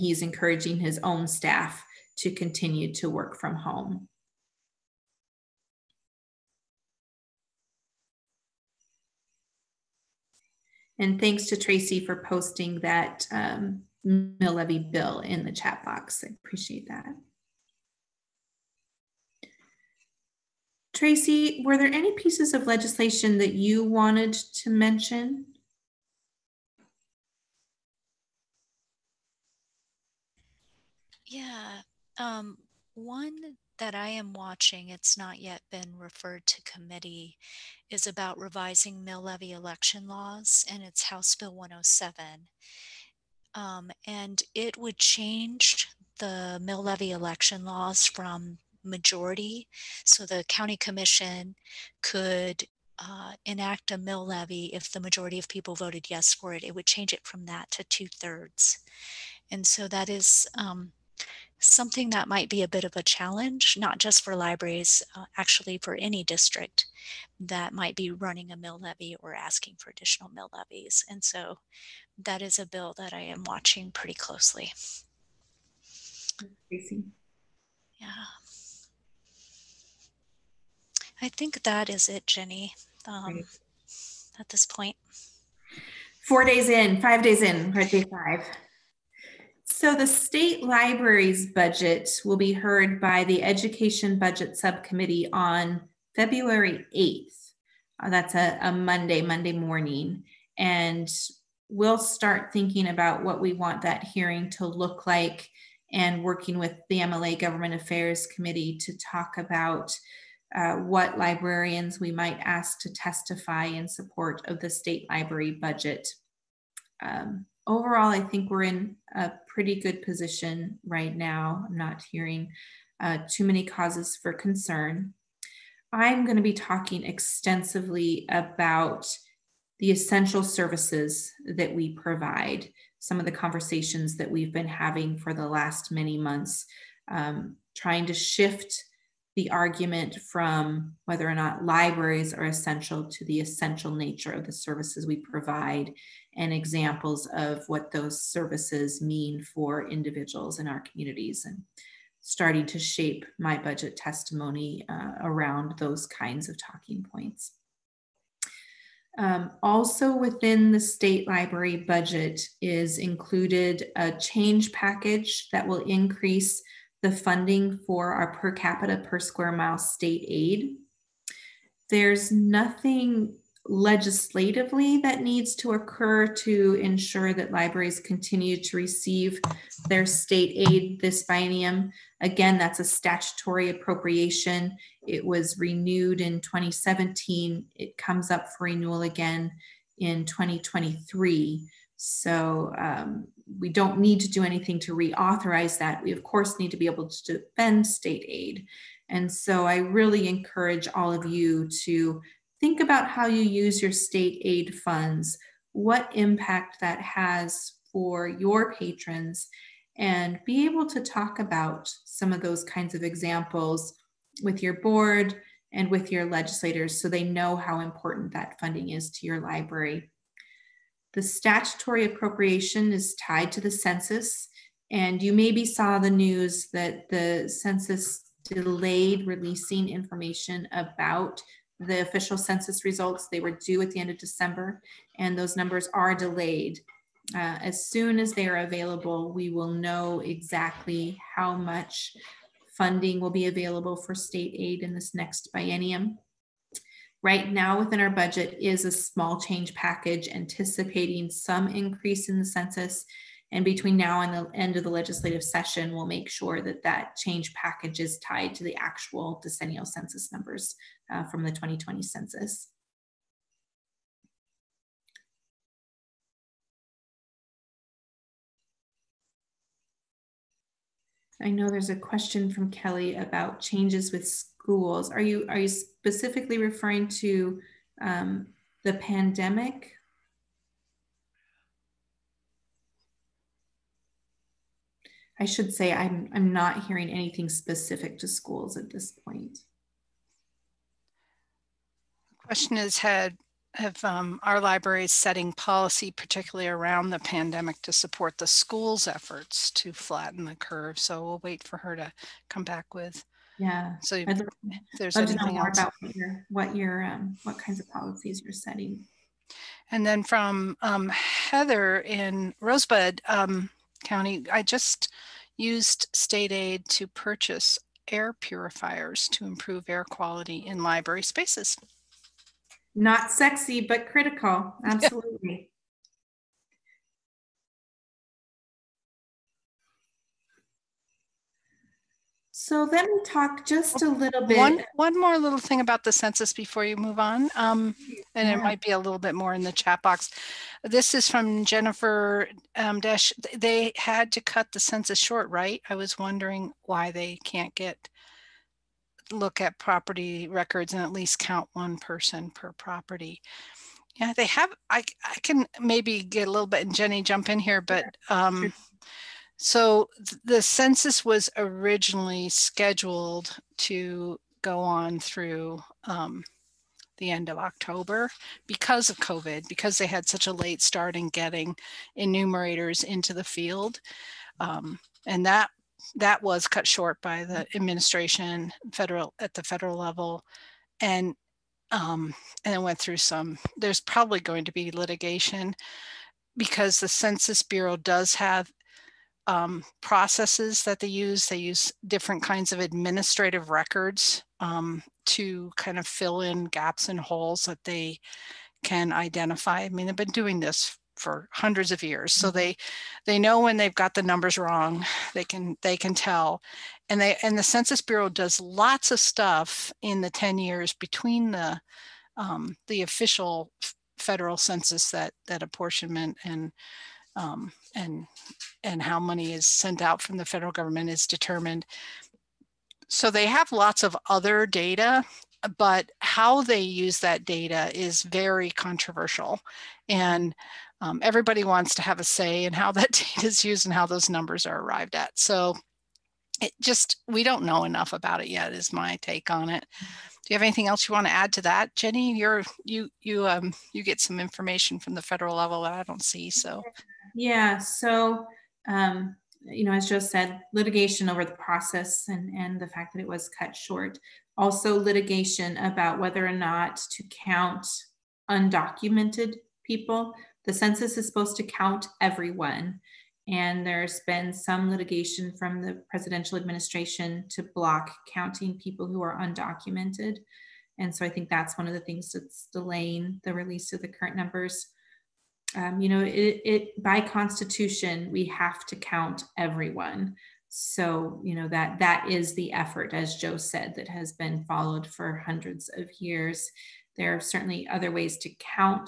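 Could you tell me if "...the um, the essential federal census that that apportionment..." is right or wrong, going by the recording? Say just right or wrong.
wrong.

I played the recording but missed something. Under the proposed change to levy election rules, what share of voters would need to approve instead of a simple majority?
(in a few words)
two thirds.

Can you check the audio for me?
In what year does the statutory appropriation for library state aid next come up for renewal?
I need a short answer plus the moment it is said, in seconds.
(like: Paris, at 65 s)
2023, at 190 s.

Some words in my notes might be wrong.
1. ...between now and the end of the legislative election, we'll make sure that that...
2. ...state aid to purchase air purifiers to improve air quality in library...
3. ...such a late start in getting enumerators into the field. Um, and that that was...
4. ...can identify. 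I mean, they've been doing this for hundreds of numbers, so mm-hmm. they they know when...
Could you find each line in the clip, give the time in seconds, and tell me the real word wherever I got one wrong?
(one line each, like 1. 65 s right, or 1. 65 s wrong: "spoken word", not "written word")
1. 253 s wrong: "session", not "election"
2. 316 s right
3. 370 s right
4. 398 s wrong: "years", not "numbers".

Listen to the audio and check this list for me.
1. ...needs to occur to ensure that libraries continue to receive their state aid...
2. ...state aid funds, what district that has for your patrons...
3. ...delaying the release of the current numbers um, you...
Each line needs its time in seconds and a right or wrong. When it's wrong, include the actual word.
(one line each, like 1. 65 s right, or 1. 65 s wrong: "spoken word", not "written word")
1. 175 s right
2. 203 s wrong: "impact", not "district"
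3. 472 s right.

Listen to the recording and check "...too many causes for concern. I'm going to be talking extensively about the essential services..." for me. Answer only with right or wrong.
right.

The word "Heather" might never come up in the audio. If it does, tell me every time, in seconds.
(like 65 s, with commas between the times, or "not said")
311 s.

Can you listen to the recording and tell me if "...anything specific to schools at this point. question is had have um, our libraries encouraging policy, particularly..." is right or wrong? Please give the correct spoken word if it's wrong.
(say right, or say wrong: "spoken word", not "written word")
wrong: "setting", not "encouraging".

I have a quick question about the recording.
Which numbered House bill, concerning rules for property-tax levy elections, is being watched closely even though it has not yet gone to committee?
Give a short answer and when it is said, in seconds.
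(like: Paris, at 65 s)
House Bill 107, at 41 s.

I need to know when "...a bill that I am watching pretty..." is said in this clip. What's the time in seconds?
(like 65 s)
72 s.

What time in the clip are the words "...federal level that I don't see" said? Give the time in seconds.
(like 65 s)
445 s.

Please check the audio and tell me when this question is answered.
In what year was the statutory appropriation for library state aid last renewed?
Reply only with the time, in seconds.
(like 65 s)
186 s.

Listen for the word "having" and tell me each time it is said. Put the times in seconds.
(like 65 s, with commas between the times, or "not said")
134 s.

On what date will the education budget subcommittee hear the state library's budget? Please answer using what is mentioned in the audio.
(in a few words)
February 8th.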